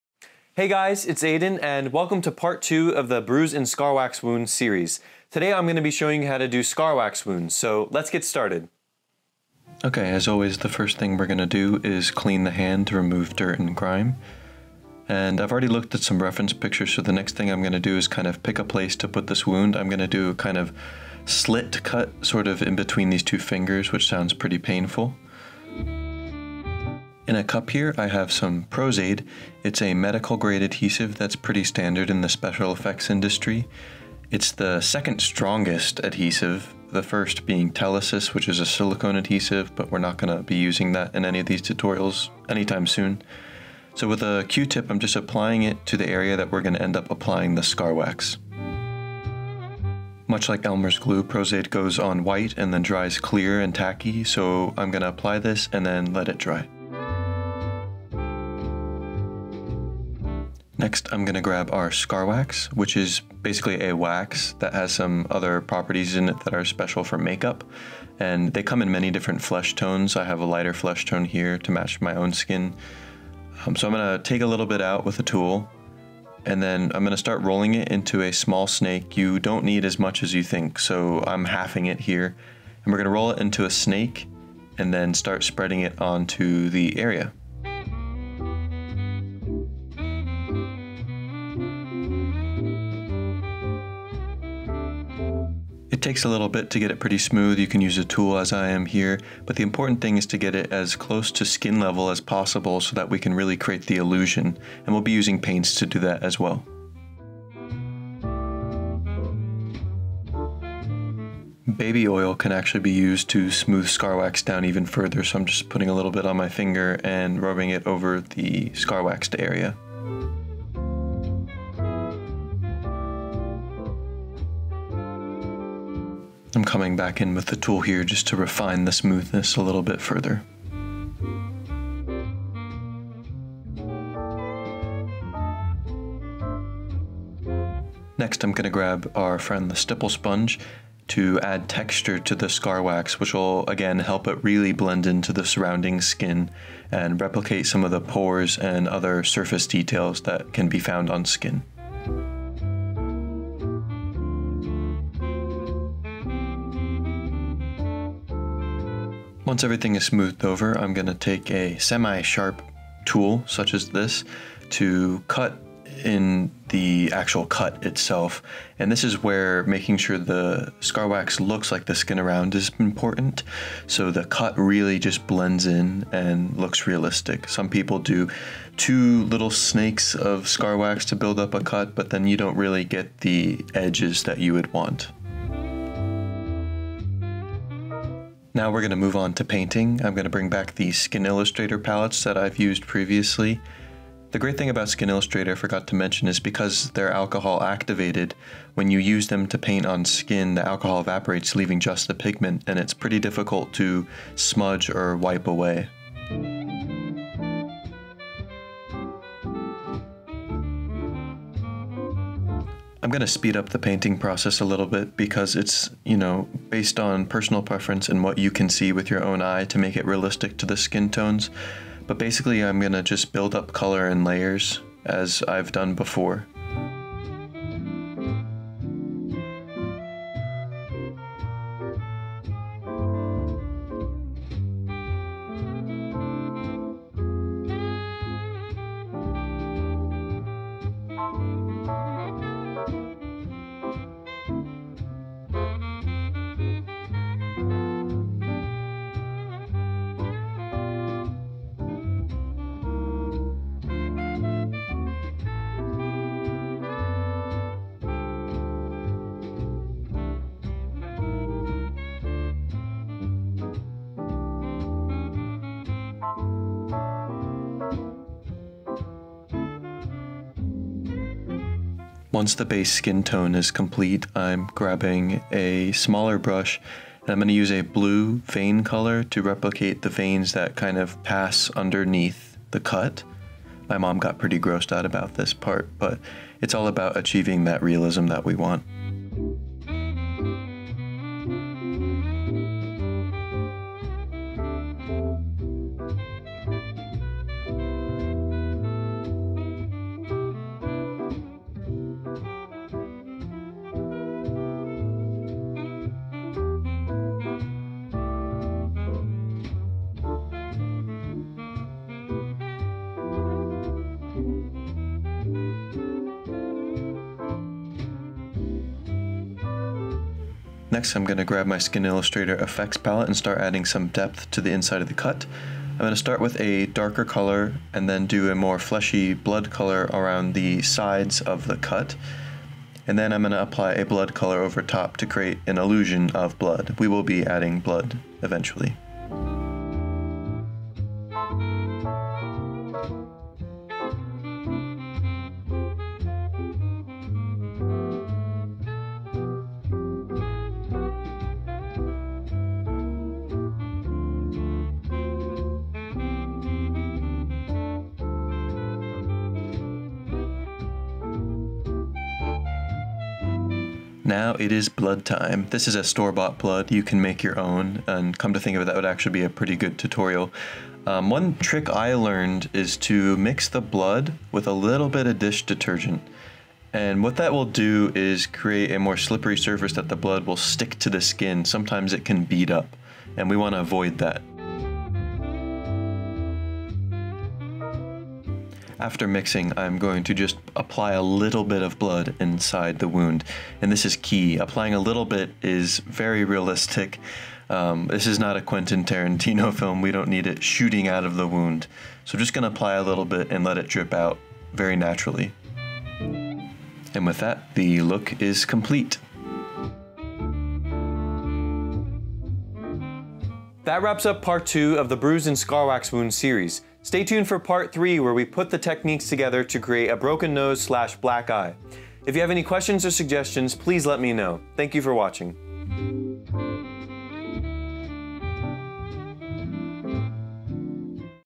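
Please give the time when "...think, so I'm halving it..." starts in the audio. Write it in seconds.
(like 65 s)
80 s.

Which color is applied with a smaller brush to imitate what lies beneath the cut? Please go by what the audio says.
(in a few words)
Blue.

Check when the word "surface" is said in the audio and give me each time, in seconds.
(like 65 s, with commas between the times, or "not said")
149 s, 379 s.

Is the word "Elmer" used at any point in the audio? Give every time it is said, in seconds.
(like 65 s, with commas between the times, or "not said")
50 s.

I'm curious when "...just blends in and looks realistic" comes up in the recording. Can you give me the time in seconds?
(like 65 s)
174 s.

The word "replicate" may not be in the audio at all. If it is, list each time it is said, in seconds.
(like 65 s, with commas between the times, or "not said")
147 s, 279 s.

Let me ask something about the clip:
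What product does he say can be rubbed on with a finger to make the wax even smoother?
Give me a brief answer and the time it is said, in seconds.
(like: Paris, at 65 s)
Baby oil, at 111 s.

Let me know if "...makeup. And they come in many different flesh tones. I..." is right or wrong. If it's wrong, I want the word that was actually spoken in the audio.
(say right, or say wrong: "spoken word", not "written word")
right.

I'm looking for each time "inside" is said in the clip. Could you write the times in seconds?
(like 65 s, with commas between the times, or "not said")
324 s, 392 s.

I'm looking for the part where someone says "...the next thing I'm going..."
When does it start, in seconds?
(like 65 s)
17 s.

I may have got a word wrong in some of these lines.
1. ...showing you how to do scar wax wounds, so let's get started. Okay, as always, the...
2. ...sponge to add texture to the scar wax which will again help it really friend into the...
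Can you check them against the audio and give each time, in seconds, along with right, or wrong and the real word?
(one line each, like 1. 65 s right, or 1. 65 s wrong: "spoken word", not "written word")
1. 5 s right
2. 140 s wrong: "blend", not "friend".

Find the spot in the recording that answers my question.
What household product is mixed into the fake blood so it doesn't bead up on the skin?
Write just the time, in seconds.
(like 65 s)
375 s.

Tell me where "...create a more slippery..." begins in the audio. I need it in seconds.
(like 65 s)
378 s.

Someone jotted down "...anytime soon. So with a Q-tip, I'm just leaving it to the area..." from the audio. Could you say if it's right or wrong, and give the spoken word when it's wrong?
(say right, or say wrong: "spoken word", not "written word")
wrong: "applying", not "leaving".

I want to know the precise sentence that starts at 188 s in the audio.
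Now we're going to move on to painting.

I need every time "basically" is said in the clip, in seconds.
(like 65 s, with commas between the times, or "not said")
63 s, 222 s.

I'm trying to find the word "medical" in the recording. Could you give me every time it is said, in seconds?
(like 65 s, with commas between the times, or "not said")
29 s.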